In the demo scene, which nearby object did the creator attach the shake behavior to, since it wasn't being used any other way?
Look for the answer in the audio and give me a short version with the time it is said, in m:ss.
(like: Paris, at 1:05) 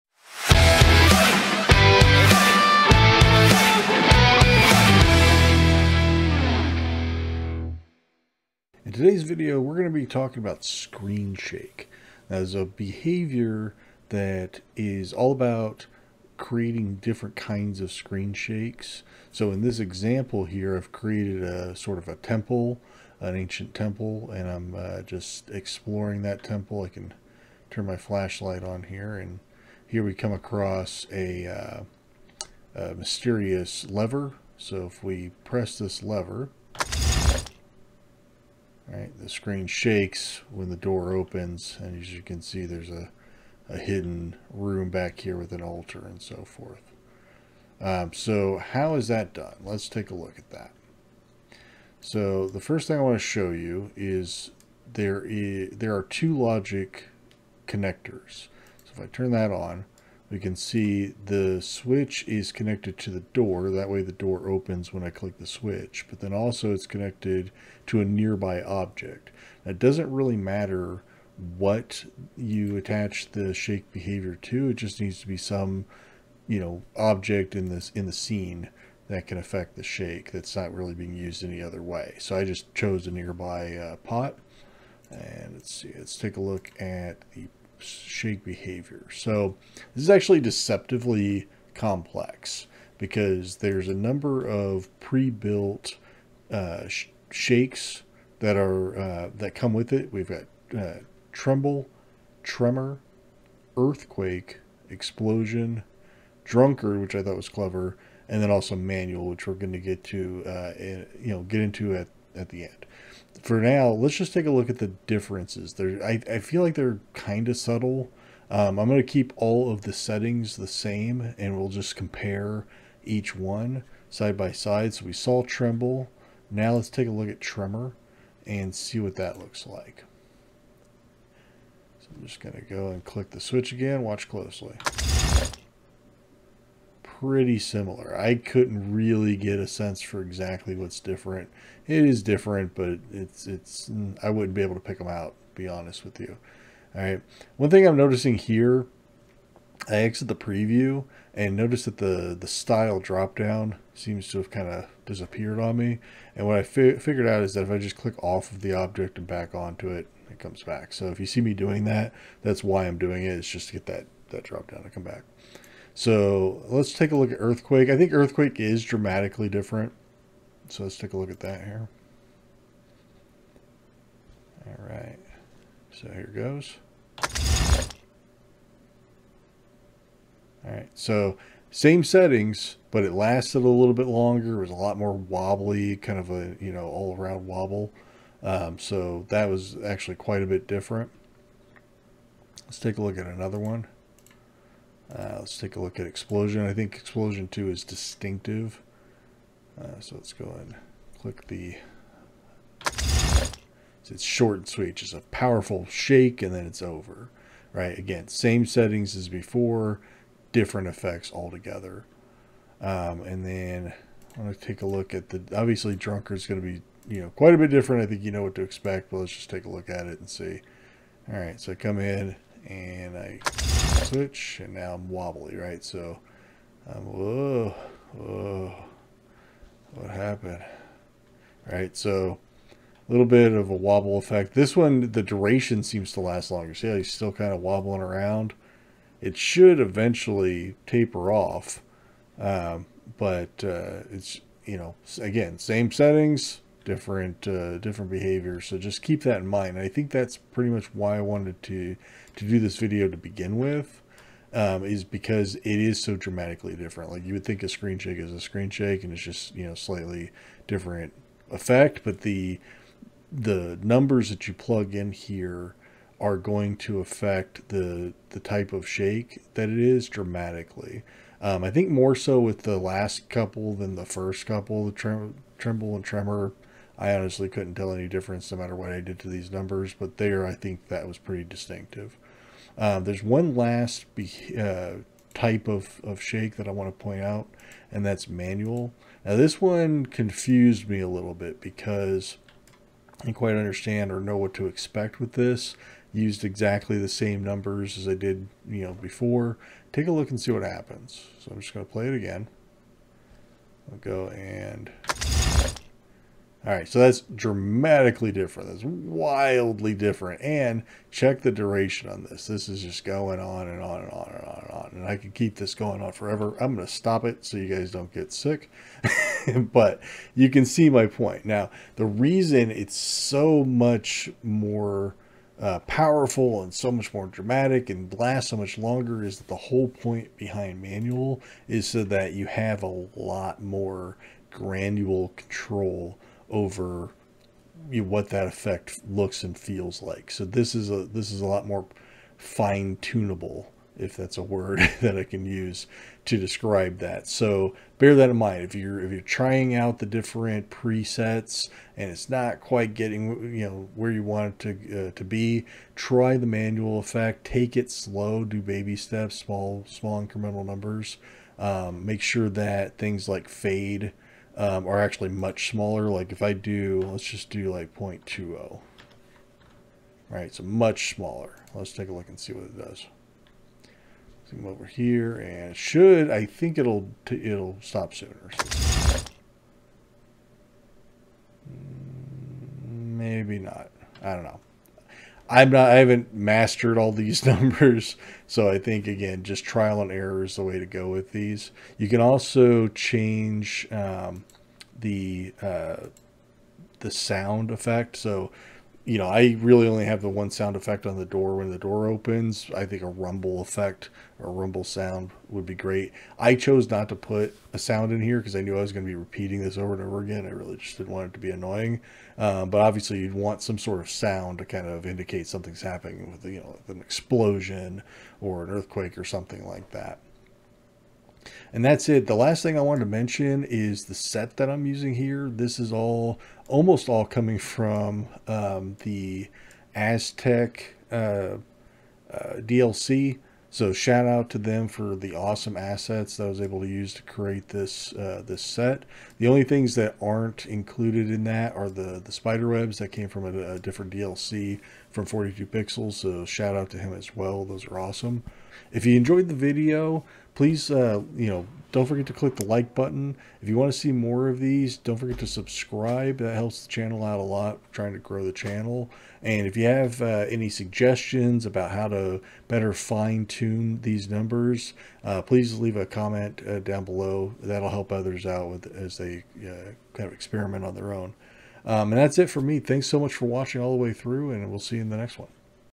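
pot, at 1:23.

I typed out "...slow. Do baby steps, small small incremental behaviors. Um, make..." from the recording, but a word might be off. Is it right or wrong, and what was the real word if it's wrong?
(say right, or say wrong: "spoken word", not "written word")
wrong: "numbers", not "behaviors".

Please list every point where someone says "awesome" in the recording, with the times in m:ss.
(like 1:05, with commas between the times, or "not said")
7:15, 7:27.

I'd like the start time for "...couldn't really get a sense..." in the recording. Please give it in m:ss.
2:18.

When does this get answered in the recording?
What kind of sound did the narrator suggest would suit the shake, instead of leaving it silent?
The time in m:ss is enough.
6:44.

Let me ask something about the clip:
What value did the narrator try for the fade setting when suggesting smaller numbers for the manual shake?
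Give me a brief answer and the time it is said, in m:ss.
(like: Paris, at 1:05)
0.20, at 6:07.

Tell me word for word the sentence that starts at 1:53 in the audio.
For now, let's just take a look at the differences.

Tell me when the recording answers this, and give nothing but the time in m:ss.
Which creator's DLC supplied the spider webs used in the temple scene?
7:25.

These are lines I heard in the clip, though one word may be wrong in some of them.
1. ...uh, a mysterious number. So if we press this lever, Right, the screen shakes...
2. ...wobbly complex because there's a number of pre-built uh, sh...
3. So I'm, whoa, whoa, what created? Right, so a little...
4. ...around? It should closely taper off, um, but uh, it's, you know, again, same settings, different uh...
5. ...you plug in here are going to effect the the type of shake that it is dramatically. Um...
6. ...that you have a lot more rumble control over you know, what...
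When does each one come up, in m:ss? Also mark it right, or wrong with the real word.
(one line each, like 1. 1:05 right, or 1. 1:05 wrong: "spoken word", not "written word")
1. 0:31 wrong: "lever", not "number"
2. 1:30 wrong: "deceptively", not "wobbly"
3. 3:45 wrong: "happened", not "created"
4. 3:58 wrong: "eventually", not "closely"
5. 4:24 wrong: "affect", not "effect"
6. 5:32 wrong: "granule", not "rumble".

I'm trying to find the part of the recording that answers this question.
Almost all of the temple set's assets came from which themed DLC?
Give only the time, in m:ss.
7:09.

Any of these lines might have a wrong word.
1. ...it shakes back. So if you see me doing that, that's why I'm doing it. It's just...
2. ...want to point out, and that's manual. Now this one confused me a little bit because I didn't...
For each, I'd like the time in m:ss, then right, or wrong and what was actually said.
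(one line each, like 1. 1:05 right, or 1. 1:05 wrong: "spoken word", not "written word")
1. 2:40 wrong: "comes", not "shakes"
2. 4:46 right.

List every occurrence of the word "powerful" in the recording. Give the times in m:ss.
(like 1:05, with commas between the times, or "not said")
3:25, 5:25.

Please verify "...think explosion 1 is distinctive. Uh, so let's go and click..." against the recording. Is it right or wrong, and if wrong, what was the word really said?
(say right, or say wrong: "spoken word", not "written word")
wrong: "2", not "1".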